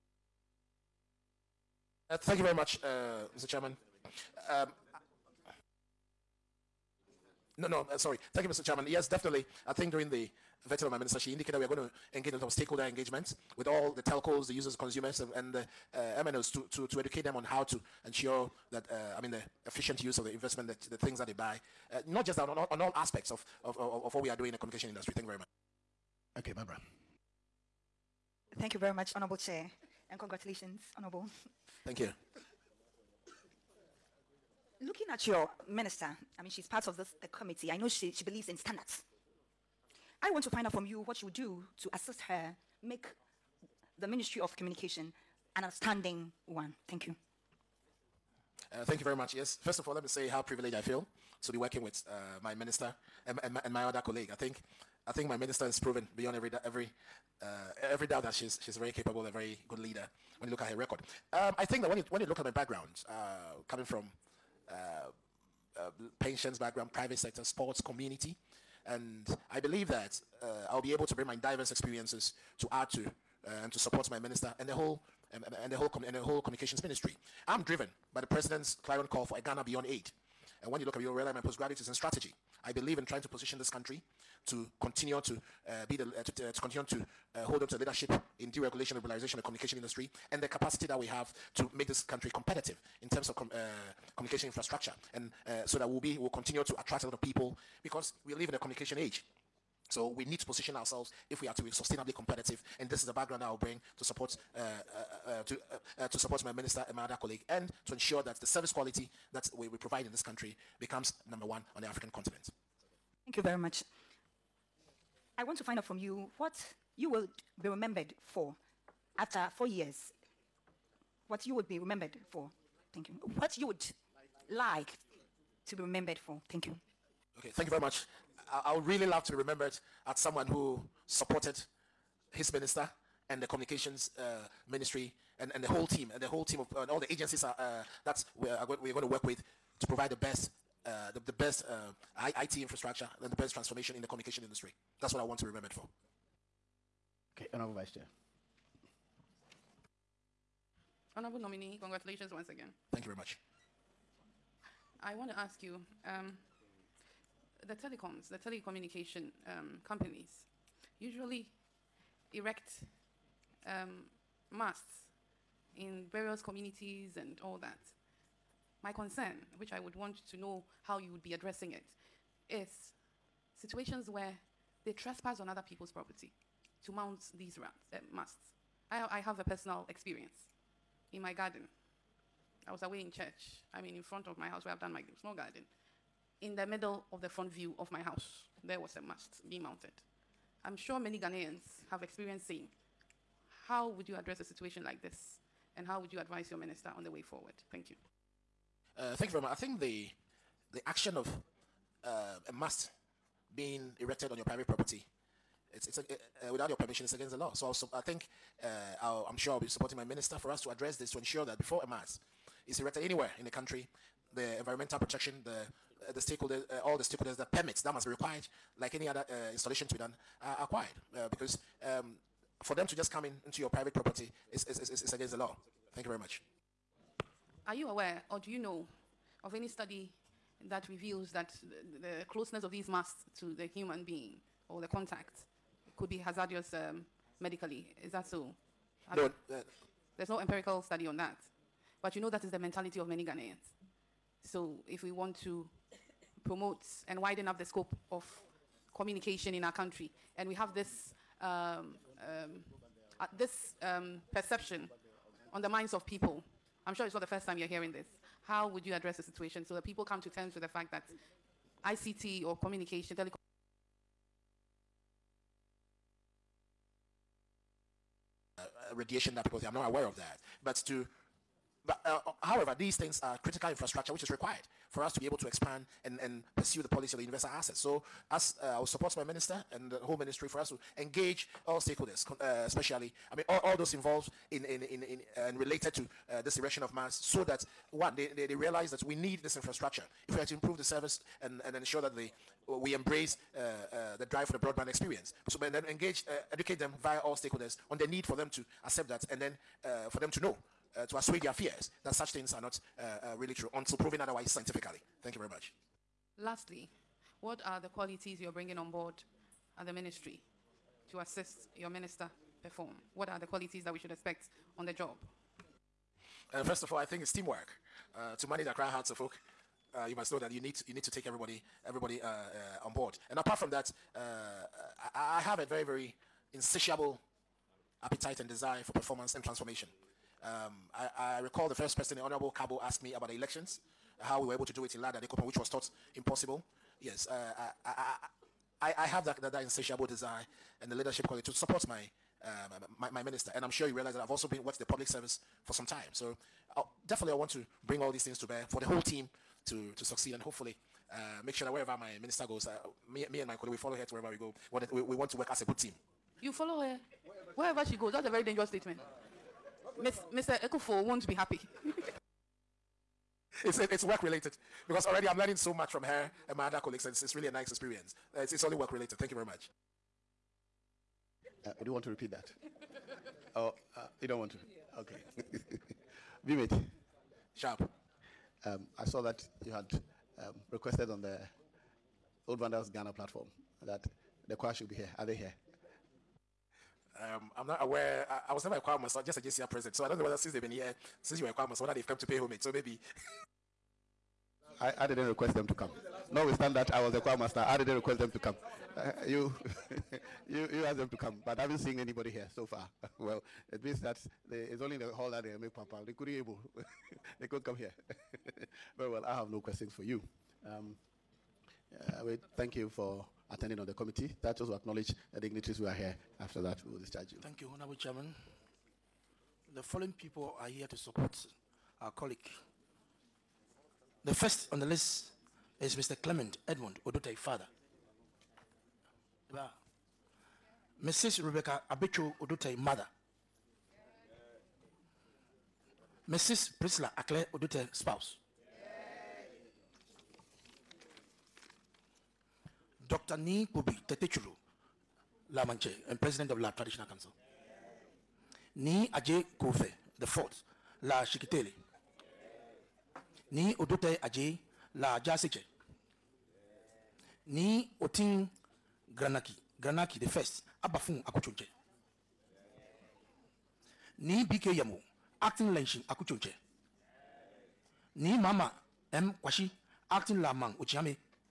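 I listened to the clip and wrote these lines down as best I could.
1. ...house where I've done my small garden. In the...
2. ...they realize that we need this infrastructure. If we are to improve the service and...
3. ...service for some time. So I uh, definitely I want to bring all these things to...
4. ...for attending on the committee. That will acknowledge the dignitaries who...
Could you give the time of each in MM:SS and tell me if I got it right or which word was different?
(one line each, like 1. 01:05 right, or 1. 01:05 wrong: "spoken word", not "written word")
1. 03:04 right
2. 04:48 right
3. 05:45 right
4. 06:52 right.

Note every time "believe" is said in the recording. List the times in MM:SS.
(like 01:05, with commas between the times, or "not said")
00:38, 01:09, 01:22.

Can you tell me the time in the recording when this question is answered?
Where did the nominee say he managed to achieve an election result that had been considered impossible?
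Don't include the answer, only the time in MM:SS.
05:35.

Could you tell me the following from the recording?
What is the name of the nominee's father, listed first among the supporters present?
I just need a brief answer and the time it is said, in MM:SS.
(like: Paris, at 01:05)
Clement Edmund Odotei, at 07:06.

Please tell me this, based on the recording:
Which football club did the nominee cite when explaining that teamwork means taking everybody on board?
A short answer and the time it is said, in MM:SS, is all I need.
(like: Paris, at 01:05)
Hearts of Oak, at 05:18.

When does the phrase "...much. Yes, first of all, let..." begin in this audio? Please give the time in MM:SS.
00:49.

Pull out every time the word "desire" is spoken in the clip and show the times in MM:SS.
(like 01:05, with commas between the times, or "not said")
05:28, 05:40.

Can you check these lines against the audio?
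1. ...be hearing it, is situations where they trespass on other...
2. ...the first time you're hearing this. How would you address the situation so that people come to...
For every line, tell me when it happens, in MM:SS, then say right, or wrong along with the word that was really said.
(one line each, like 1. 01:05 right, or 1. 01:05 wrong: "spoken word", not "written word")
1. 02:51 wrong: "addressing", not "hearing"
2. 04:17 right.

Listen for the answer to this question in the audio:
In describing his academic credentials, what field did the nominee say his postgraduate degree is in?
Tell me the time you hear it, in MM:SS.
01:21.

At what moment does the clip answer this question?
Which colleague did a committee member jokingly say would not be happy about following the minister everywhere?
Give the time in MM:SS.
06:00.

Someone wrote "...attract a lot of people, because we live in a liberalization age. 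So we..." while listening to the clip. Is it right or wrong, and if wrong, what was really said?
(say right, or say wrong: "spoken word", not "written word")
wrong: "communication", not "liberalization".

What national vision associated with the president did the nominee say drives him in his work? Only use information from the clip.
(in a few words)
Ghana beyond aid.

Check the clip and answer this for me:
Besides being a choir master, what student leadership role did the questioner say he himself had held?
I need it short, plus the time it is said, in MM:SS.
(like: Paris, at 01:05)
JCR president, at 06:29.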